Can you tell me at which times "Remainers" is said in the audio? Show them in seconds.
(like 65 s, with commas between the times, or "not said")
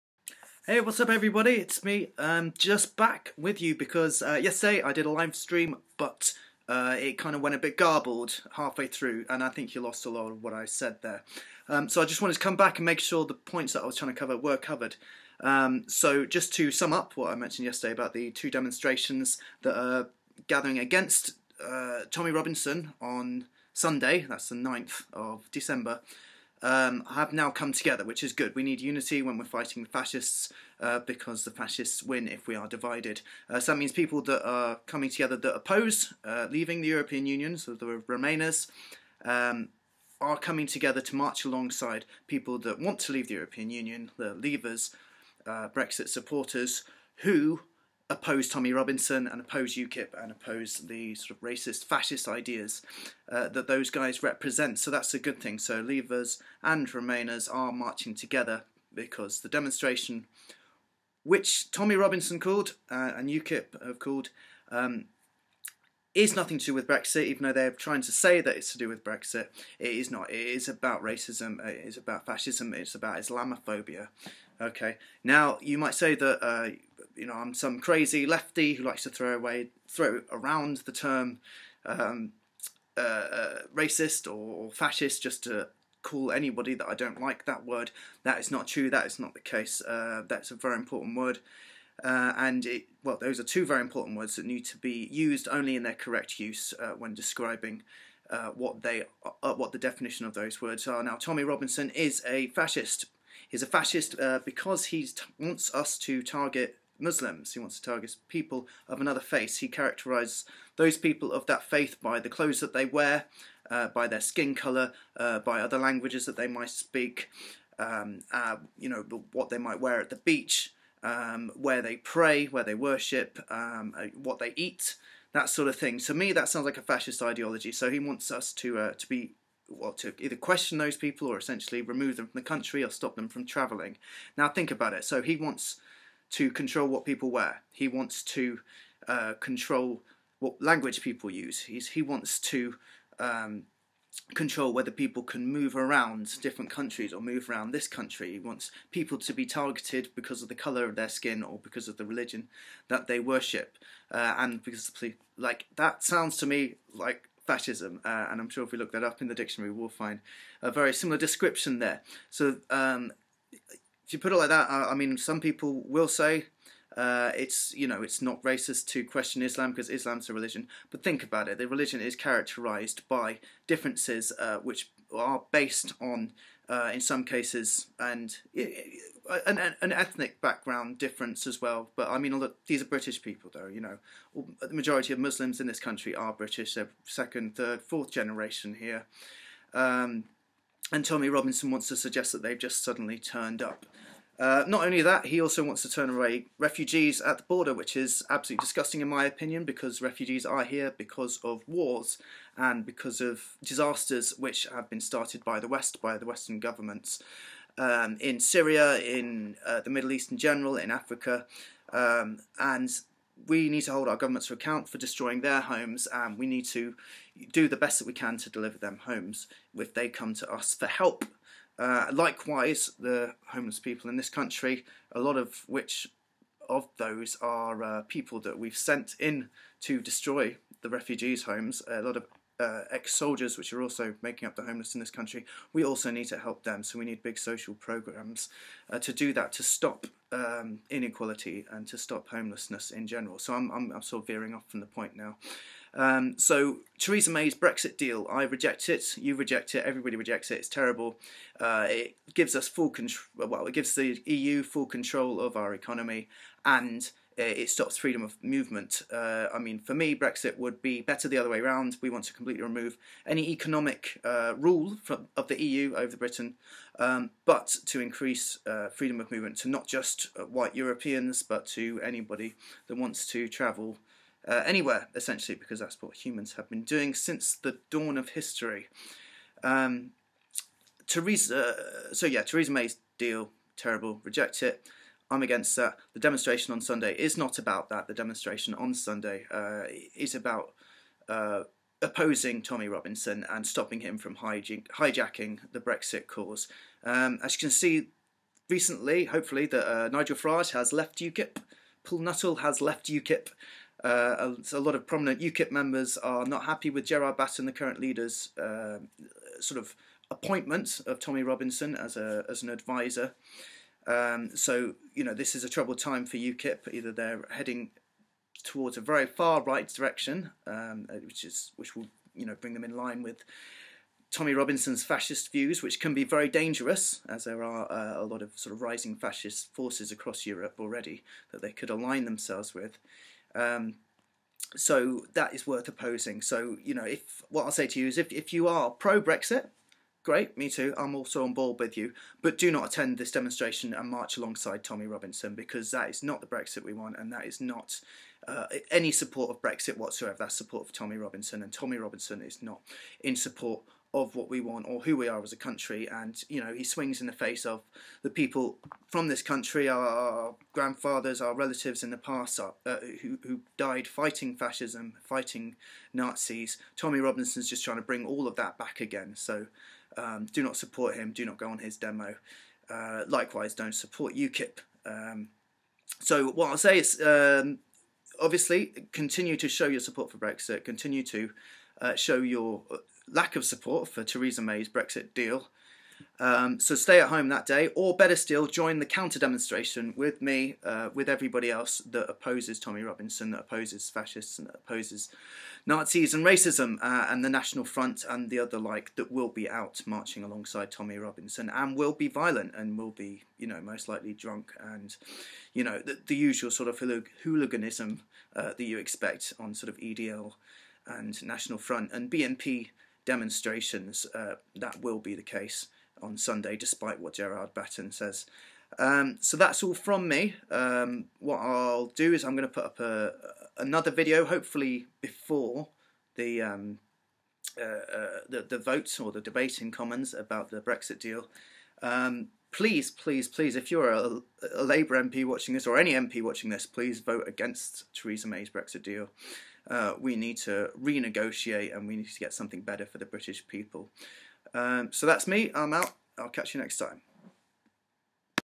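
38 s, 56 s.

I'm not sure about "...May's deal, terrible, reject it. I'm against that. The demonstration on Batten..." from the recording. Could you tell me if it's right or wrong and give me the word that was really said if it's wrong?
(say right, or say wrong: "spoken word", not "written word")
wrong: "Sunday", not "Batten".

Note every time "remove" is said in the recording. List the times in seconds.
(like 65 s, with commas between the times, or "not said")
131 s, 262 s.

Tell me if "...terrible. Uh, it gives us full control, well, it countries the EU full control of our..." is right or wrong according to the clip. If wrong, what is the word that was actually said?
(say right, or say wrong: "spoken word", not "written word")
wrong: "gives", not "countries".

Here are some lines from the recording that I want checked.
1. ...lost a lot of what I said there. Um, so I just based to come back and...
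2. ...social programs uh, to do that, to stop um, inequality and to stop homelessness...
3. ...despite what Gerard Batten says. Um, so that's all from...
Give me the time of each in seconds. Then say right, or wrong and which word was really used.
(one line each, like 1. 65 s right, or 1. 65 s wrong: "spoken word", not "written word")
1. 9 s wrong: "wanted", not "based"
2. 237 s right
3. 416 s right.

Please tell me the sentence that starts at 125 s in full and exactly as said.
To me, that sounds like a fascist ideology.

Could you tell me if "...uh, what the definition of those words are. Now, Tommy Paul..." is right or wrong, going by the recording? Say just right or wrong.
wrong.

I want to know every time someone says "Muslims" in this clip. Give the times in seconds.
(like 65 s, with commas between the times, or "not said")
106 s, 185 s.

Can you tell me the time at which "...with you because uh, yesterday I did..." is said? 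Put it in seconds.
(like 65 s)
3 s.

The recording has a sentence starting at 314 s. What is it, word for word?
Um, so you know this is a troubled time for UKIP.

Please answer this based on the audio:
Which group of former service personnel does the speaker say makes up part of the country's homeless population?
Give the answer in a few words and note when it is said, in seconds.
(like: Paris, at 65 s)
ex-soldiers, at 232 s.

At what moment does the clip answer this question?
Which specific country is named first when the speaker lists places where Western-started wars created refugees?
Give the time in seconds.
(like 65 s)
208 s.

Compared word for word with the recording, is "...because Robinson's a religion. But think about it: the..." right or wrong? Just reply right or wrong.
wrong.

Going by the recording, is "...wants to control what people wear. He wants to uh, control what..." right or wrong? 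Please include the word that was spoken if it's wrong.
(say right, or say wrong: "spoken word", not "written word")
right.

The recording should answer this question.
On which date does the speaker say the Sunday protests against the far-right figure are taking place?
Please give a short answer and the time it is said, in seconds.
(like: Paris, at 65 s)
9th of December, at 24 s.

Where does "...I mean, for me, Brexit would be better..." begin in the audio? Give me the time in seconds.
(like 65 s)
259 s.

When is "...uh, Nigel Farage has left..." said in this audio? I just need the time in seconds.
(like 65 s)
299 s.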